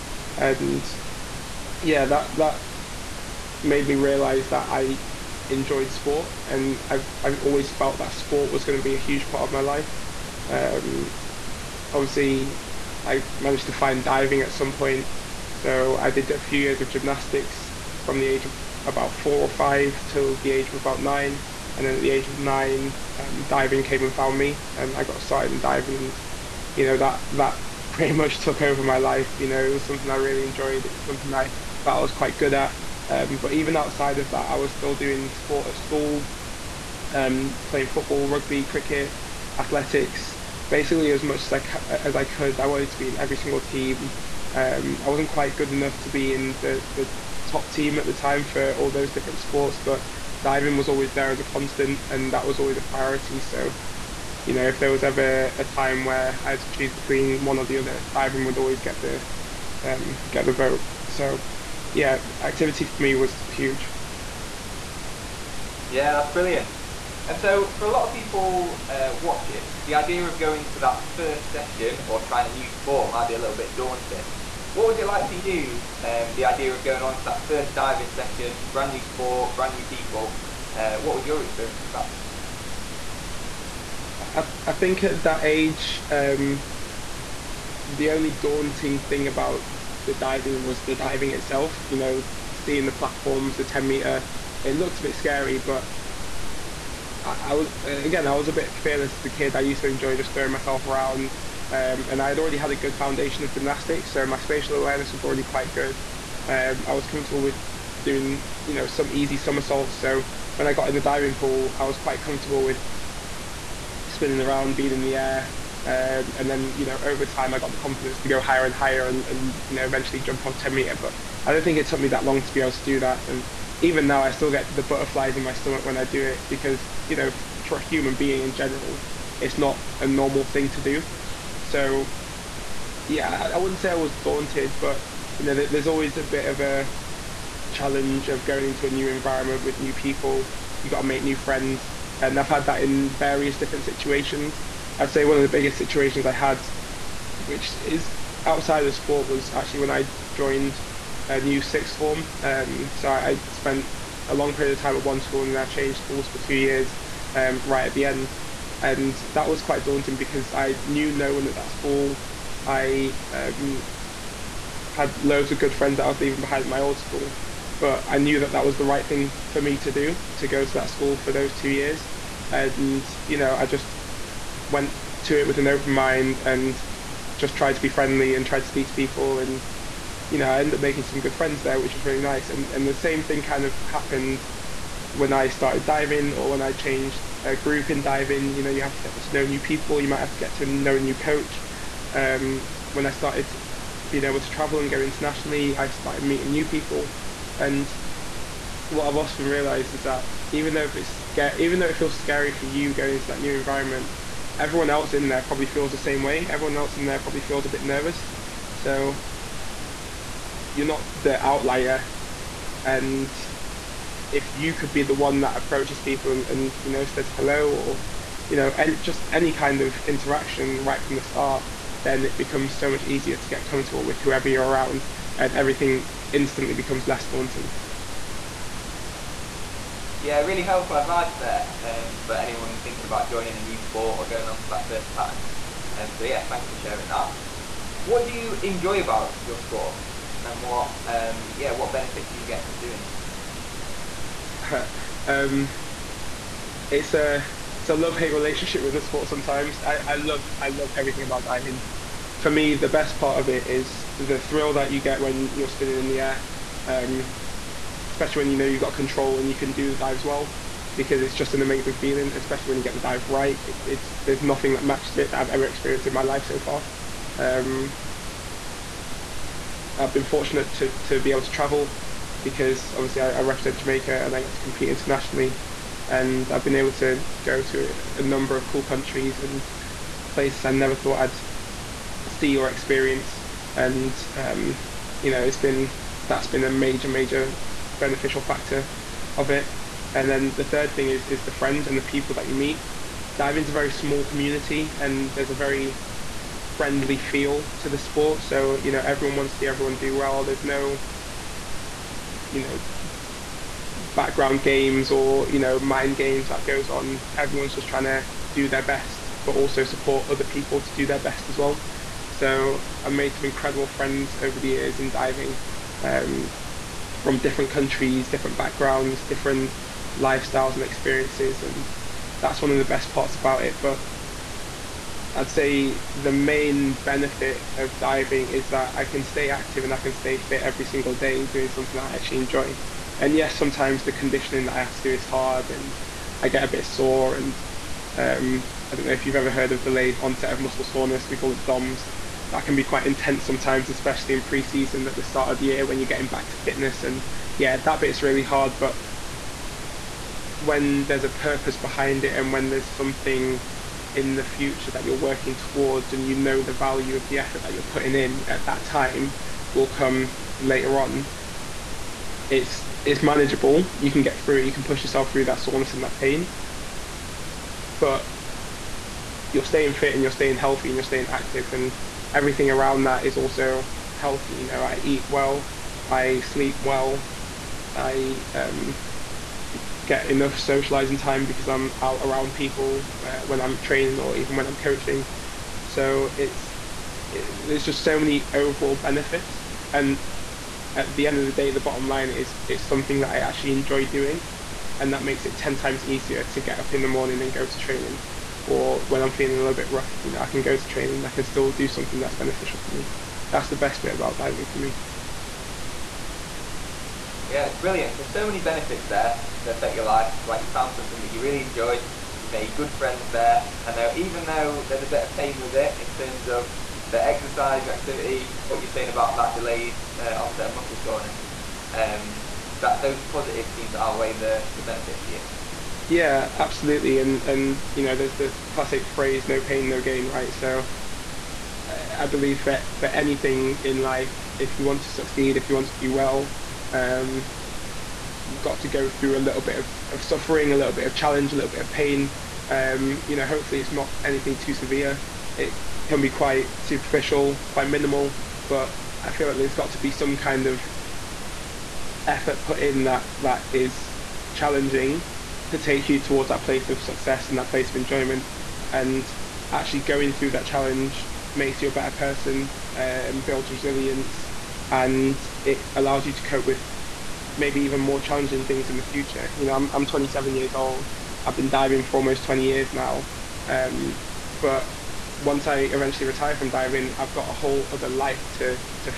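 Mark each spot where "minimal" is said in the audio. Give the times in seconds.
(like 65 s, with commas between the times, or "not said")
447 s.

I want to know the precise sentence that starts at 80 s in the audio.
Uh, what was your experience of that?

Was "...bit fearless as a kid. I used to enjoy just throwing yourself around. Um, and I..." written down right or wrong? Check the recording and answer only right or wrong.
wrong.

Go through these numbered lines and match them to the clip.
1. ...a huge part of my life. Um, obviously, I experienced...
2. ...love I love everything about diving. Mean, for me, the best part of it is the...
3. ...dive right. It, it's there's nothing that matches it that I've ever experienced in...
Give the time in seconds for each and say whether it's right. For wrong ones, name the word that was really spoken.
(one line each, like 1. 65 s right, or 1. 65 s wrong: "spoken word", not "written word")
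1. 8 s wrong: "managed", not "experienced"
2. 250 s right
3. 262 s right.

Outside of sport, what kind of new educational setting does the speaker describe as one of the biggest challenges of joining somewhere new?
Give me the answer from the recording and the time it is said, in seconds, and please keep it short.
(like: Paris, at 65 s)
Sixth form, at 151 s.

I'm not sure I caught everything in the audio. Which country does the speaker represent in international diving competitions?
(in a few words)
Jamaica.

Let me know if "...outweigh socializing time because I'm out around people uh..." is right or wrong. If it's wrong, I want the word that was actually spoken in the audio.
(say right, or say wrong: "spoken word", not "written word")
wrong: "enough", not "outweigh".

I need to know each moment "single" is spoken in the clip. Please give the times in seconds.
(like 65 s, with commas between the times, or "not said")
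43 s, 330 s.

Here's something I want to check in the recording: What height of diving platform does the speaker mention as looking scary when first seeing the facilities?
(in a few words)
10 meter.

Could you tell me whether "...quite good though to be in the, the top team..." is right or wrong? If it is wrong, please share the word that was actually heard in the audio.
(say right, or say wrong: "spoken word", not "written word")
wrong: "enough", not "though".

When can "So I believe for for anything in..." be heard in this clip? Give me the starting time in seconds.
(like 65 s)
430 s.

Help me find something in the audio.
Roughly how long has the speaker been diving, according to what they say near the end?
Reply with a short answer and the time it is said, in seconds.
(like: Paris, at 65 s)
Almost 20 years, at 472 s.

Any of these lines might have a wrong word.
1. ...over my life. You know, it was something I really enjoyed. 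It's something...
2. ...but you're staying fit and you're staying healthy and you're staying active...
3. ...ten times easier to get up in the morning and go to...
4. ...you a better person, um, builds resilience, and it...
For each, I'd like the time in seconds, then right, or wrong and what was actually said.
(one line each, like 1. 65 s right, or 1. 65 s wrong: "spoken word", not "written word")
1. 28 s right
2. 367 s right
3. 395 s right
4. 461 s right.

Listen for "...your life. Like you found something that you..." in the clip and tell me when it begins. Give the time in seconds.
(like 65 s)
409 s.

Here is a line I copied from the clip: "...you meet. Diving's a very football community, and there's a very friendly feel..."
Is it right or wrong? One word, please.
wrong.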